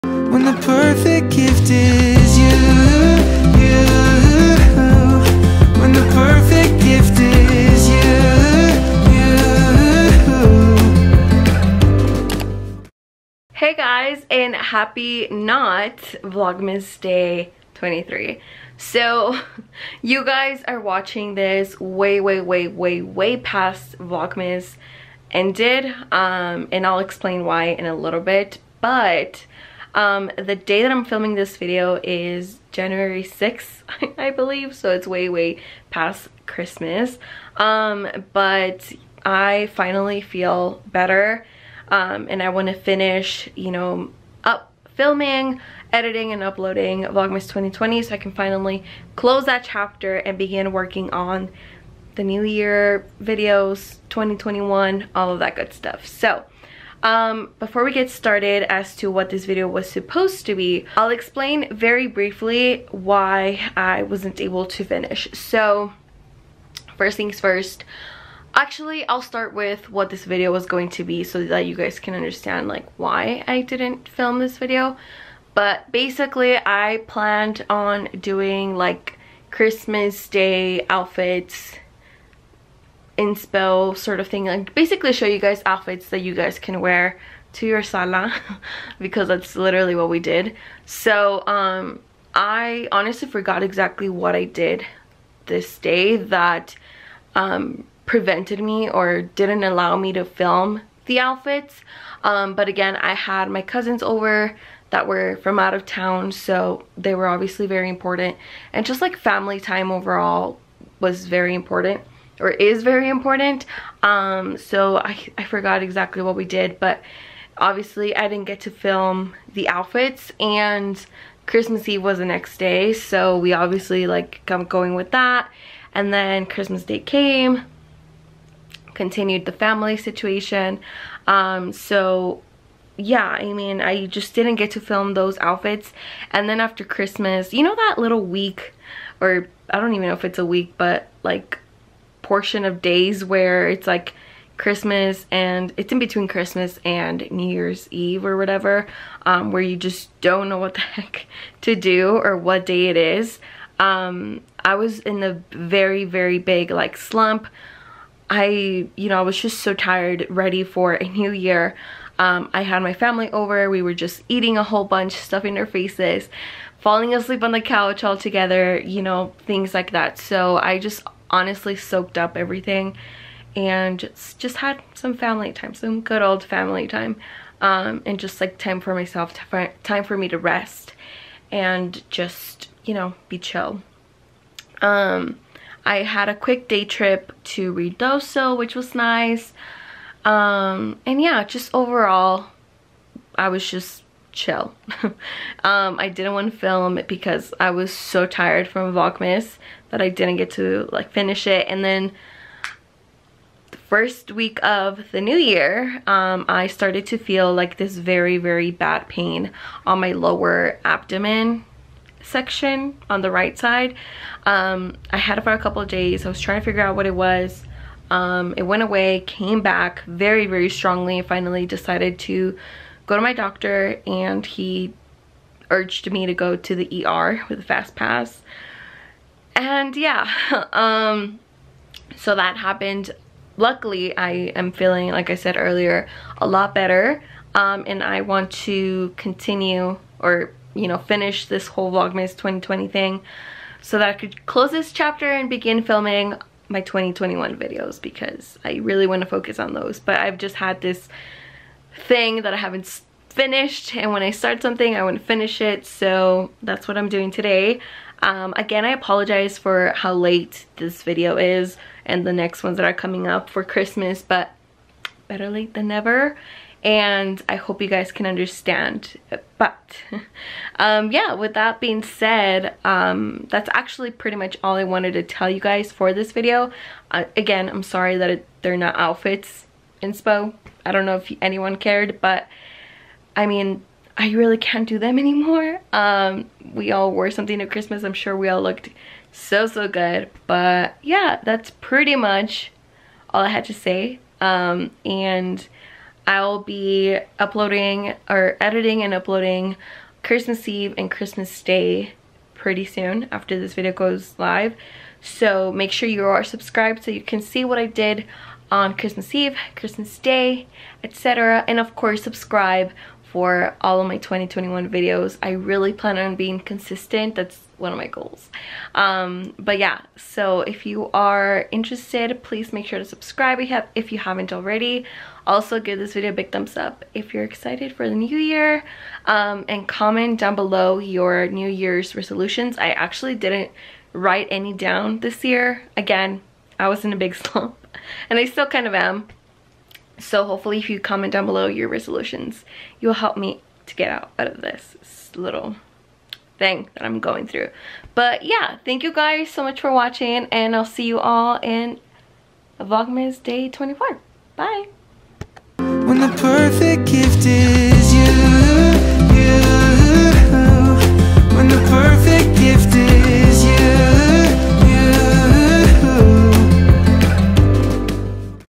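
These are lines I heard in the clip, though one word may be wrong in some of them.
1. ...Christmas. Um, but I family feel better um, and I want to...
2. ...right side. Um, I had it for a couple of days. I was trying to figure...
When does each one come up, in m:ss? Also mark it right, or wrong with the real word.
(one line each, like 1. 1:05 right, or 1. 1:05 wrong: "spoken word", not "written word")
1. 0:36 wrong: "finally", not "family"
2. 3:33 right.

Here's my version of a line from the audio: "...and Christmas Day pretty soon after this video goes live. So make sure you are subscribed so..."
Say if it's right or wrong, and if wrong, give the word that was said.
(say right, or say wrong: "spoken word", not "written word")
right.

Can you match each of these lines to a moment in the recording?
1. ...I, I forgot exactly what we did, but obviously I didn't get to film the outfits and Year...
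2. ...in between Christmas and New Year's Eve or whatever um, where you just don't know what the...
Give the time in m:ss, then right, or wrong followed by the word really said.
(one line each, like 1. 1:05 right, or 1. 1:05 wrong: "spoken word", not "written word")
1. 1:54 wrong: "Christmas", not "Year"
2. 2:25 right.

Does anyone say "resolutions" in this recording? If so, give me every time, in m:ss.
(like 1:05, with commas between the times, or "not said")
5:32, 5:41.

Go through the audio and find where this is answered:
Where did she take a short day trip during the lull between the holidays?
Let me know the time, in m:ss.
3:07.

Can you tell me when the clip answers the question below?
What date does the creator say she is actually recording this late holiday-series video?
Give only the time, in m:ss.
0:32.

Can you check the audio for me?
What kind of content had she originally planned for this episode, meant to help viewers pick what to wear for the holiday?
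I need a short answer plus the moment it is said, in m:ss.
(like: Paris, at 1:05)
Christmas Day outfits inspo, at 1:19.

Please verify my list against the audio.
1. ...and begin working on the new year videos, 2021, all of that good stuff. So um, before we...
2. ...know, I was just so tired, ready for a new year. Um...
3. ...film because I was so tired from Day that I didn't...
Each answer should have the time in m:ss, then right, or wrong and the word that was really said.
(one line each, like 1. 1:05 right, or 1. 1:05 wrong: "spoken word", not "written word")
1. 0:50 right
2. 2:39 right
3. 3:16 wrong: "Vlogmas", not "Day".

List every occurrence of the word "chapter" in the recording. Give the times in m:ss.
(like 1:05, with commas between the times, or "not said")
0:49, 4:04.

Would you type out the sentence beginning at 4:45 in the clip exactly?
Um, we all wore something at Christmas.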